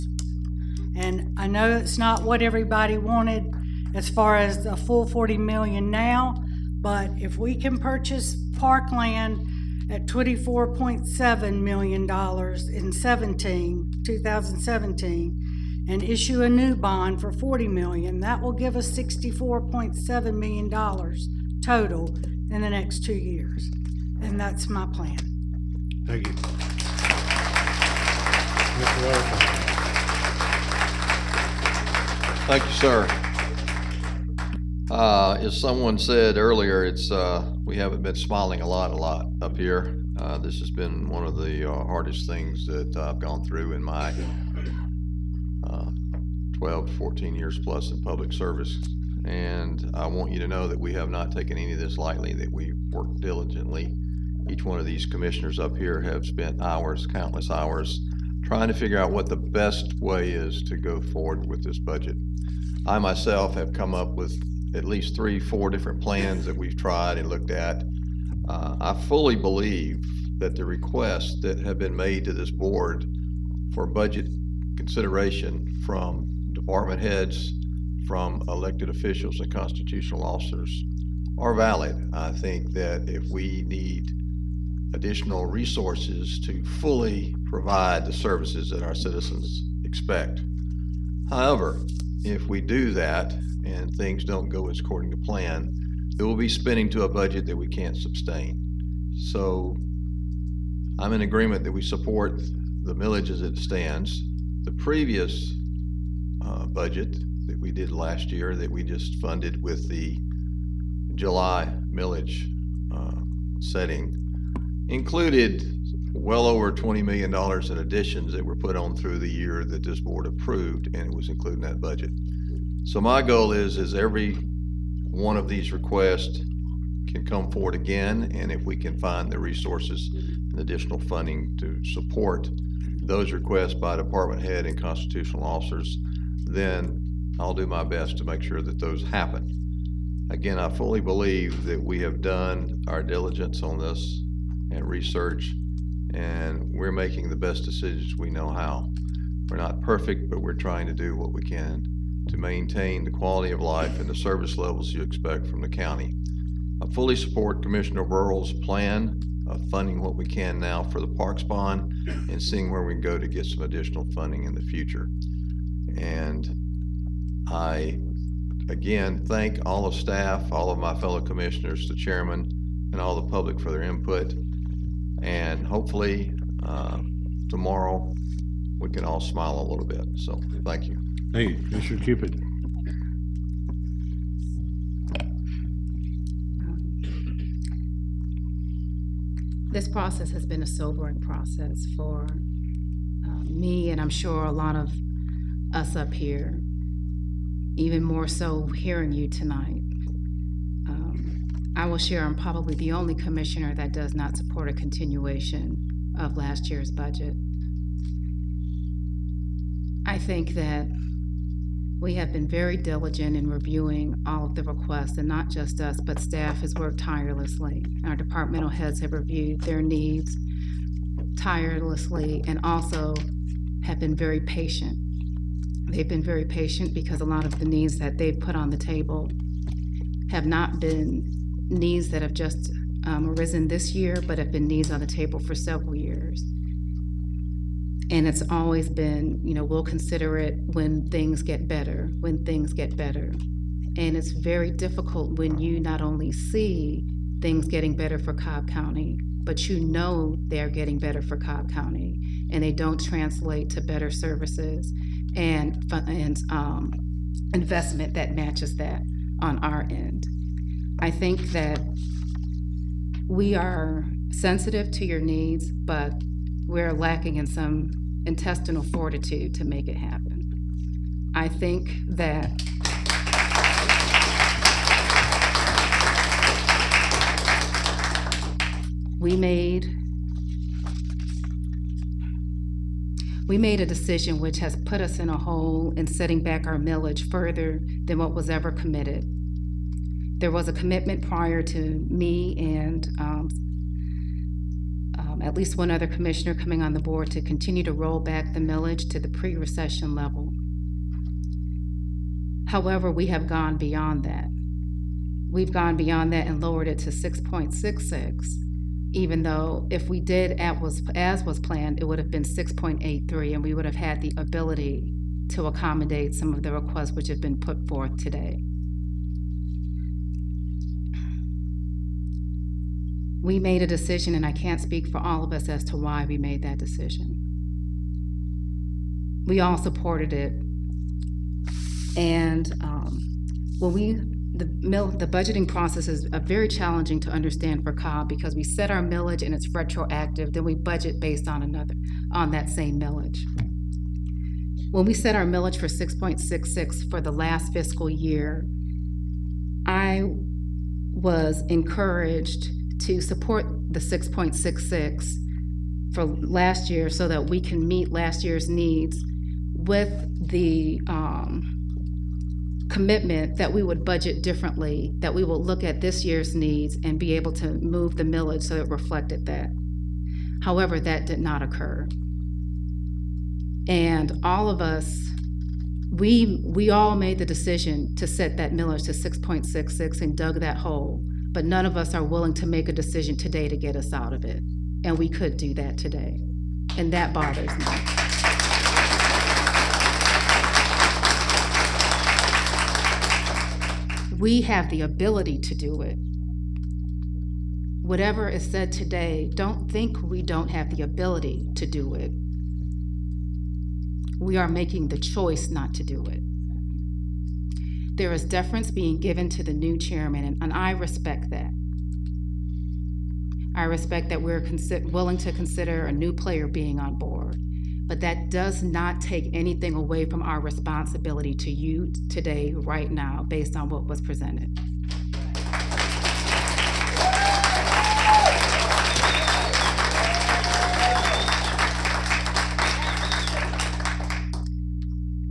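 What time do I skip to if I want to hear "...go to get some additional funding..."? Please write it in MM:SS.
02:43.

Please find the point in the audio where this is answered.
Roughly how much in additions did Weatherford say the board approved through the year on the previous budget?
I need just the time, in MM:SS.
01:56.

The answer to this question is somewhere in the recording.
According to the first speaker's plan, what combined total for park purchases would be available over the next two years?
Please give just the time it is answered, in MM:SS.
00:18.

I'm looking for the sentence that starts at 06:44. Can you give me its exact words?
We are making the choice not to do it.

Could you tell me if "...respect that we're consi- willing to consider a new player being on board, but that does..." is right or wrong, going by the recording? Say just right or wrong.
right.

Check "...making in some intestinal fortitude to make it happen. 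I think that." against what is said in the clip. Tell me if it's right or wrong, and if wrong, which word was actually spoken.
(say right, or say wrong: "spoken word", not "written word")
wrong: "lacking", not "making".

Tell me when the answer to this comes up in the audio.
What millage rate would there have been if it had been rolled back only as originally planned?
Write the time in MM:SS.
05:12.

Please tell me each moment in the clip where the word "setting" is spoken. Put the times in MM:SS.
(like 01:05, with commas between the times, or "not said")
01:53, 04:46.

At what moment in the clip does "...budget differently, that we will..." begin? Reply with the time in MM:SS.
06:04.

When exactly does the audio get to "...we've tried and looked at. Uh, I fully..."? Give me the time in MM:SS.
01:06.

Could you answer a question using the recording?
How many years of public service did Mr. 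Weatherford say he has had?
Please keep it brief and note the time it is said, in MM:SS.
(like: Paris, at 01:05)
12, 14 years, at 00:46.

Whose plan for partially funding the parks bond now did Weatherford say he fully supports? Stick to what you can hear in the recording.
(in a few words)
Commissioner Birrell.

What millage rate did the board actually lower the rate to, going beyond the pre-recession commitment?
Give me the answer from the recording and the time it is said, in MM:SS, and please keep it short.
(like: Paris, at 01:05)
6.66, at 05:07.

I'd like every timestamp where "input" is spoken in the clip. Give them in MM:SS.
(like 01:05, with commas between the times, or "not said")
02:53.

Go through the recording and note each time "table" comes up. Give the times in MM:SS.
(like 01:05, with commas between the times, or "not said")
03:48, 03:55.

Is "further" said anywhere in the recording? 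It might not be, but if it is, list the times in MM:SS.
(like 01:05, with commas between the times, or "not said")
04:47.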